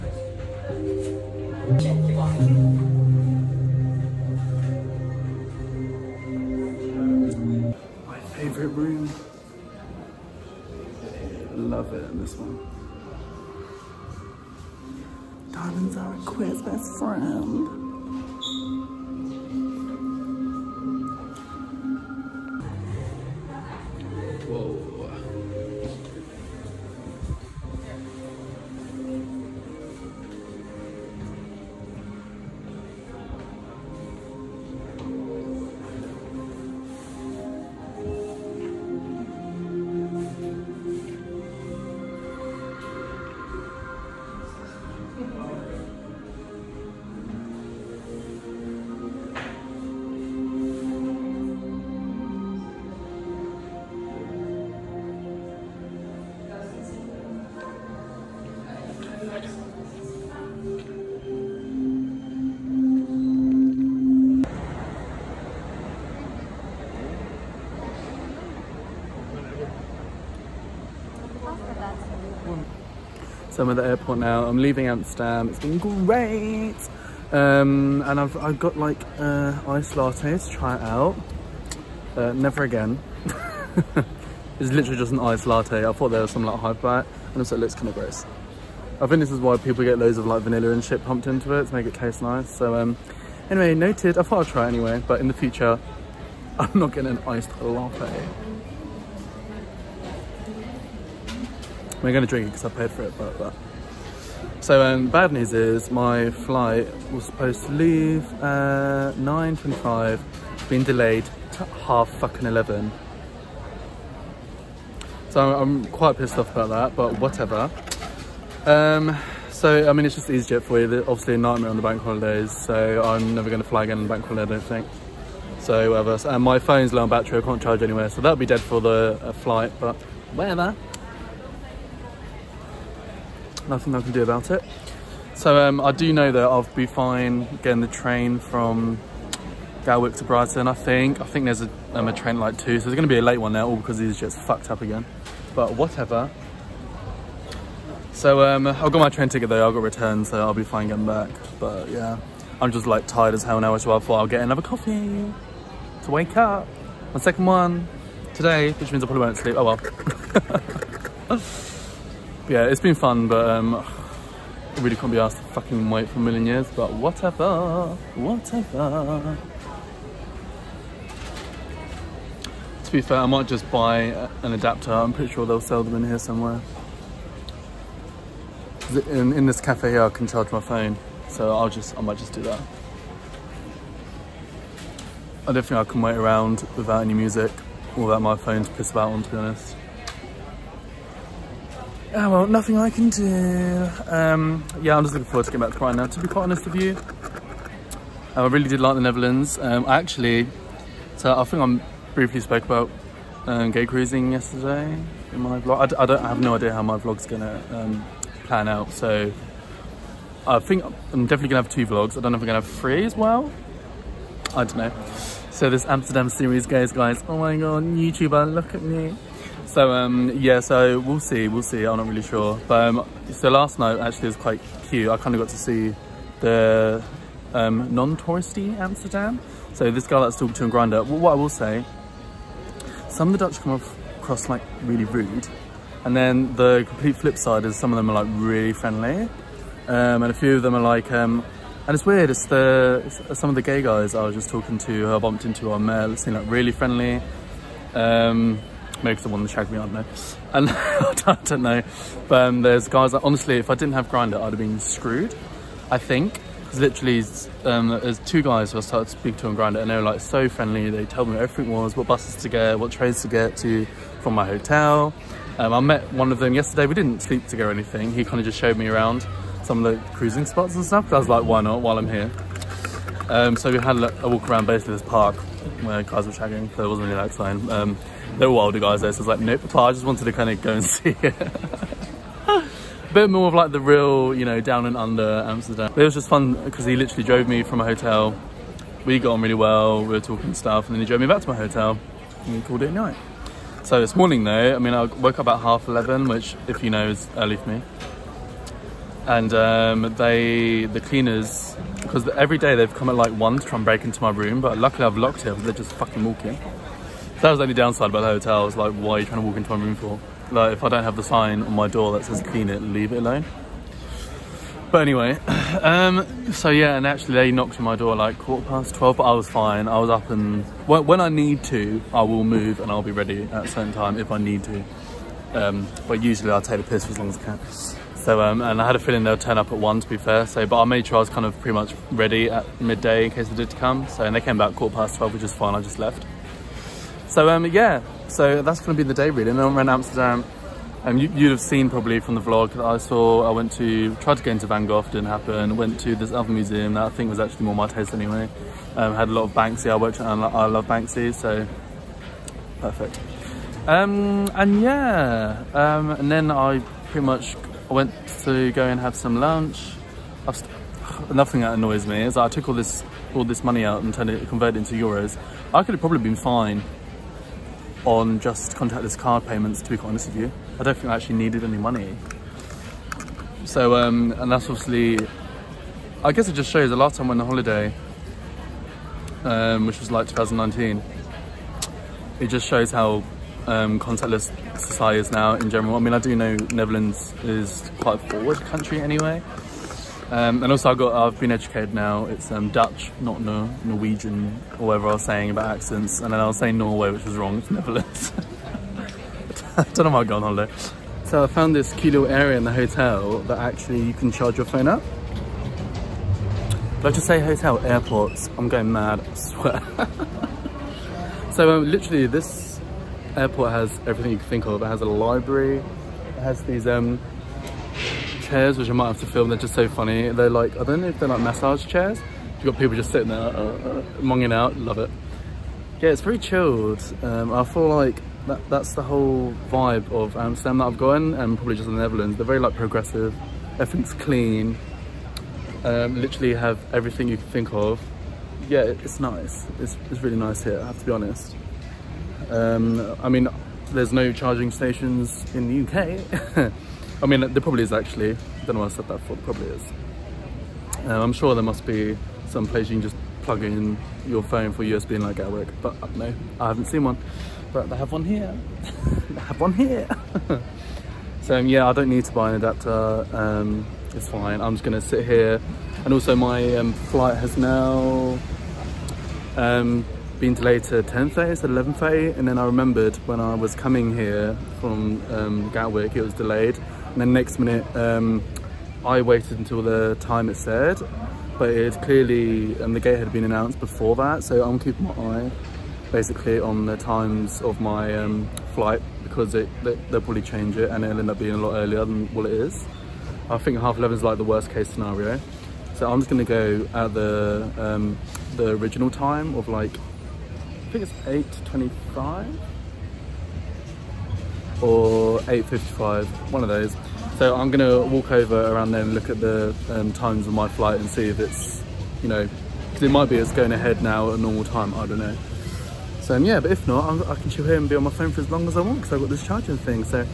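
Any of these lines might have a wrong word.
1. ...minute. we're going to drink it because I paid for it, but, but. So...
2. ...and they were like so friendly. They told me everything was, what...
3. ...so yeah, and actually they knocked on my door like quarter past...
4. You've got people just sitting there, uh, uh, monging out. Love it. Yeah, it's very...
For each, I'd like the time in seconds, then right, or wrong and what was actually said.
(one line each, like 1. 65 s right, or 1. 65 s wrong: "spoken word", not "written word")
1. 97 s wrong: "latte", not "minute"
2. 259 s right
3. 316 s right
4. 422 s right.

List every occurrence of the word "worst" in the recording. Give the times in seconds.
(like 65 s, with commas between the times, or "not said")
494 s.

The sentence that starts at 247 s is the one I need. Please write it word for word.
Um, maybe the one that shagged me, I don't know.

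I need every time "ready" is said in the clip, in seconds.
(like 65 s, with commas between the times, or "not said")
323 s, 332 s.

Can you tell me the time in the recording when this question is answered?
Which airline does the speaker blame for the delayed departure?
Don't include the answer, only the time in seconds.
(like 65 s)
120 s.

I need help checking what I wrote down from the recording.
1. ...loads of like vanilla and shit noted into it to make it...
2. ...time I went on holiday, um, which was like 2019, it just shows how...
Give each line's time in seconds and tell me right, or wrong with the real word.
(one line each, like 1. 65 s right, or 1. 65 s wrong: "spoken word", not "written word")
1. 89 s wrong: "pumped", not "noted"
2. 377 s right.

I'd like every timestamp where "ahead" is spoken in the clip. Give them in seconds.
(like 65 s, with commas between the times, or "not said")
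513 s.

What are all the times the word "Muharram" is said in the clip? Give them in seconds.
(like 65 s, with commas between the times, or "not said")
not said.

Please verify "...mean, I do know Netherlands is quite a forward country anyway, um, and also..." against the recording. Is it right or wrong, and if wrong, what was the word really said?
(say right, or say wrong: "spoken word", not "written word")
right.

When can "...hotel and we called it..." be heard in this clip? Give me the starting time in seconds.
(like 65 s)
291 s.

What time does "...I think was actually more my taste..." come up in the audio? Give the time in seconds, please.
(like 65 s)
347 s.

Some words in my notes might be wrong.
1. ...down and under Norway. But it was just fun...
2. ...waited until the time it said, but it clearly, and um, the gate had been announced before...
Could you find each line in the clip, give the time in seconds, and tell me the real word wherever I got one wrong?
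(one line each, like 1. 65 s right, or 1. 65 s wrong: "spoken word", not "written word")
1. 284 s wrong: "Amsterdam", not "Norway"
2. 479 s right.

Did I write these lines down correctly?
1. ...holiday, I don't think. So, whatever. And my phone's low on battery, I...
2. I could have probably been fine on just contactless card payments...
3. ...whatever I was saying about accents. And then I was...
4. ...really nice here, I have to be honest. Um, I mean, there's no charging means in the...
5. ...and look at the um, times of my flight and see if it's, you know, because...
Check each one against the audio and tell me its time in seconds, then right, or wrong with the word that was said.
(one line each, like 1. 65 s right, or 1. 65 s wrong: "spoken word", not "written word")
1. 124 s right
2. 365 s right
3. 394 s right
4. 440 s wrong: "stations", not "means"
5. 509 s right.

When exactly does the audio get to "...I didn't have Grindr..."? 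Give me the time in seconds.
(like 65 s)
253 s.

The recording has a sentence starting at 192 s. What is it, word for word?
Yeah, oh, well, nothing I can do.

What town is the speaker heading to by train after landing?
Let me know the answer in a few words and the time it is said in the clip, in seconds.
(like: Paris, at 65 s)
Brighton, at 140 s.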